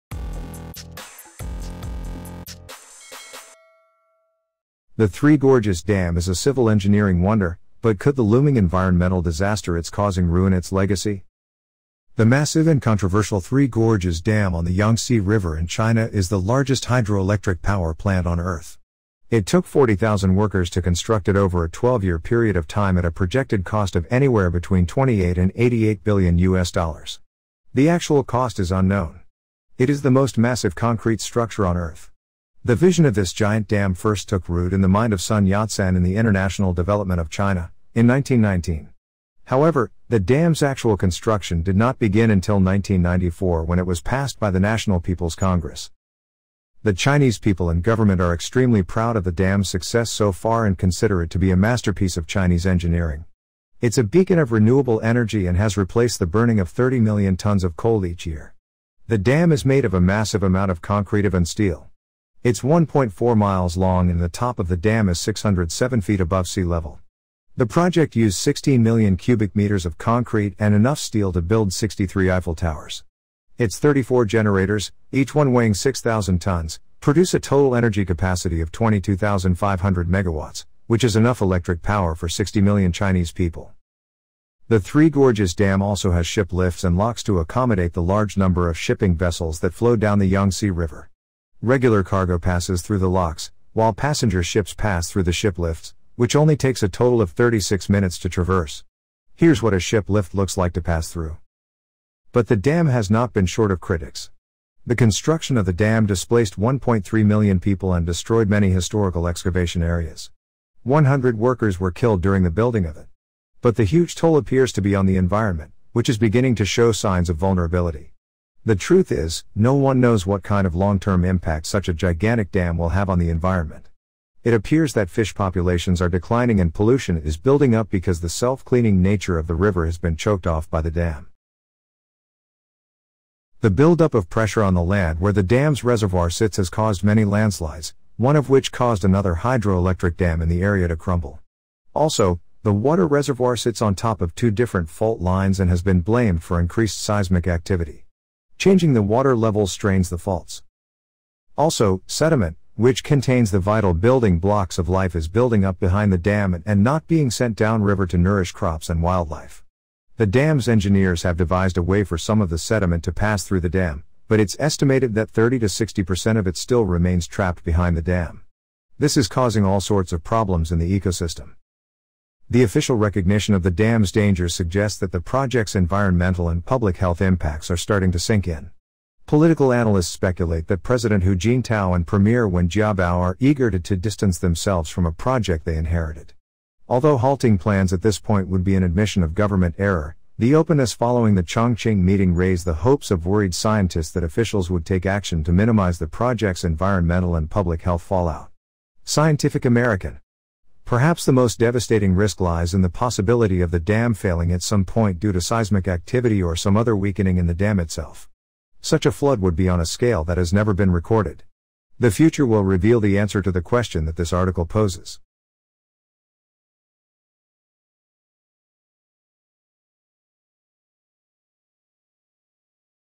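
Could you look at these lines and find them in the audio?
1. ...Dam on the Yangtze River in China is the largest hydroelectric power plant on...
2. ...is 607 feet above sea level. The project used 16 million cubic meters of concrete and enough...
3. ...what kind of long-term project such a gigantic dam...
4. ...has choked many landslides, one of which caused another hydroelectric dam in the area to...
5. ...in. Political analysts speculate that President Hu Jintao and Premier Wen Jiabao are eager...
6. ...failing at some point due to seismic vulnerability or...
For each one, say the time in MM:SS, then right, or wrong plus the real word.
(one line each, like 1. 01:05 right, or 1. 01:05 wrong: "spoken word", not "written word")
1. 00:14 right
2. 01:05 right
3. 02:00 wrong: "impact", not "project"
4. 02:16 wrong: "caused", not "choked"
5. 02:58 right
6. 03:24 wrong: "activity", not "vulnerability".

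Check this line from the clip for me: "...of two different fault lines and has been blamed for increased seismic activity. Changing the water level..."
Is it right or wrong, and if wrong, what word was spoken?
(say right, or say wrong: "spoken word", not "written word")
right.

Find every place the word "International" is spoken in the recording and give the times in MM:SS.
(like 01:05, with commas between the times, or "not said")
00:36.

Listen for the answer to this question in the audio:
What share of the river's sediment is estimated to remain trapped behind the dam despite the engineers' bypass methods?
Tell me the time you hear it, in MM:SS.
02:45.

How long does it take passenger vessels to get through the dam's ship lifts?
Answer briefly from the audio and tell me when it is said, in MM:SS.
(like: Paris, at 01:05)
36 minutes, at 01:37.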